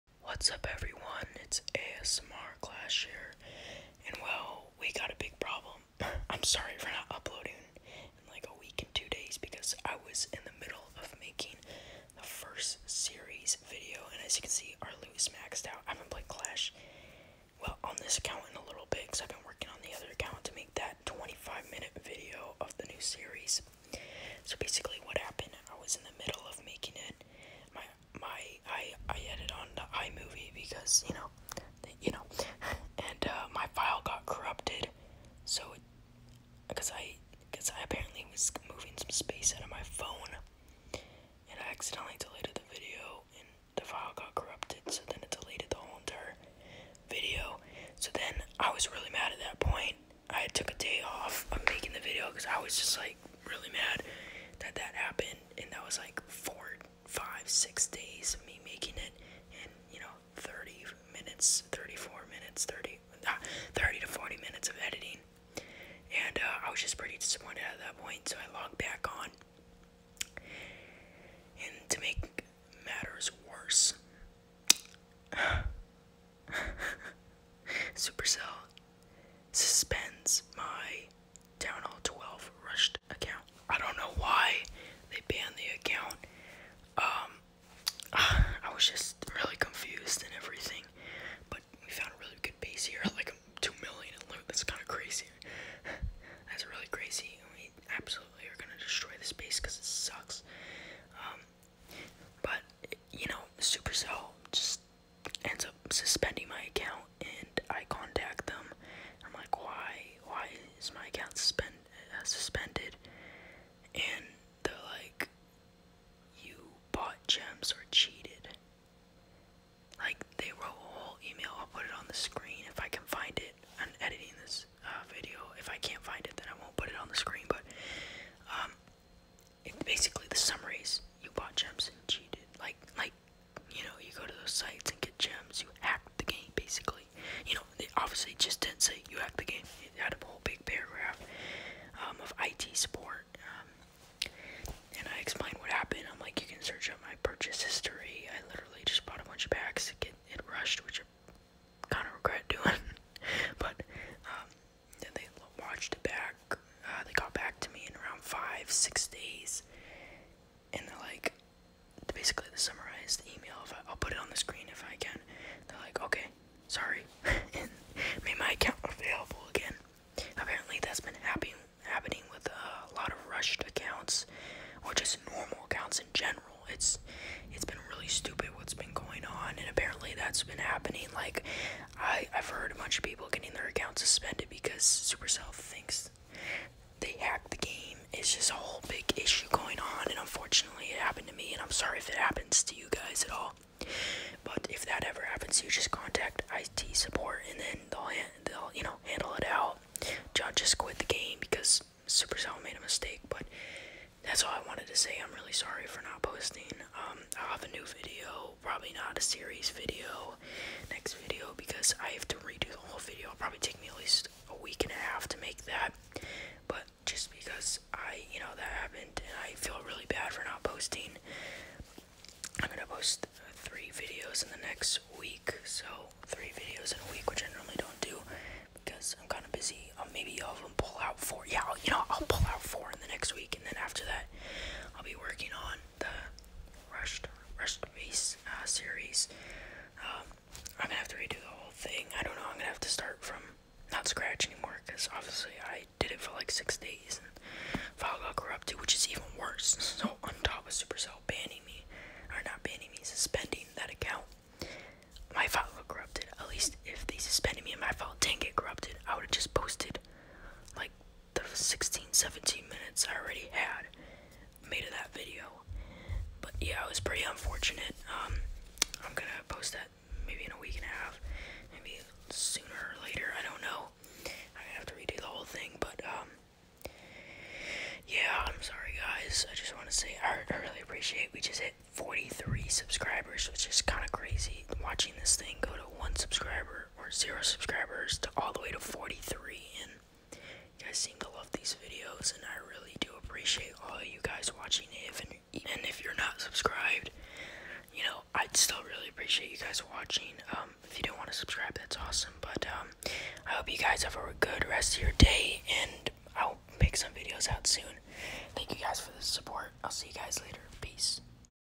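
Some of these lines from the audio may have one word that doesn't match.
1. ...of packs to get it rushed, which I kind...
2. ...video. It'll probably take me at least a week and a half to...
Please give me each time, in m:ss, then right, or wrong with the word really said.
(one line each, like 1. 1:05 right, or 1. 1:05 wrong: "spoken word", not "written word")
1. 2:29 right
2. 3:32 right.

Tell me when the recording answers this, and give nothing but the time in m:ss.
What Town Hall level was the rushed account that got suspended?
1:21.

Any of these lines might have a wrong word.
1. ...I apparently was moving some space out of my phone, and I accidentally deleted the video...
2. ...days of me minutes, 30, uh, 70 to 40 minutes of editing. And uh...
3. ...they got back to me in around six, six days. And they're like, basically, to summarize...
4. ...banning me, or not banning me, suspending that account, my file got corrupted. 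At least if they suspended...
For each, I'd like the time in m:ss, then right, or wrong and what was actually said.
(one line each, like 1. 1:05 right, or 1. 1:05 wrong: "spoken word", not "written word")
1. 0:37 right
2. 0:57 wrong: "30", not "70"
3. 2:37 wrong: "five", not "six"
4. 4:11 right.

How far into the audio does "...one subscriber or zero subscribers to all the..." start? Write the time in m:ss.
4:46.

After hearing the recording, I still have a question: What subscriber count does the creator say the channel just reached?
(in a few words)
43.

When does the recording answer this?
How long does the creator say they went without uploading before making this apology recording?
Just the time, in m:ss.
0:08.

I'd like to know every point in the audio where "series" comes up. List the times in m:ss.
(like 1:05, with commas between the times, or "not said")
3:29, 3:58.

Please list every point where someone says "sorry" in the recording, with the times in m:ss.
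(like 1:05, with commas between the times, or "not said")
0:06, 3:11, 3:25, 4:38.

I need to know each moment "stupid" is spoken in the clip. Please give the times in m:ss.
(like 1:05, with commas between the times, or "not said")
2:58.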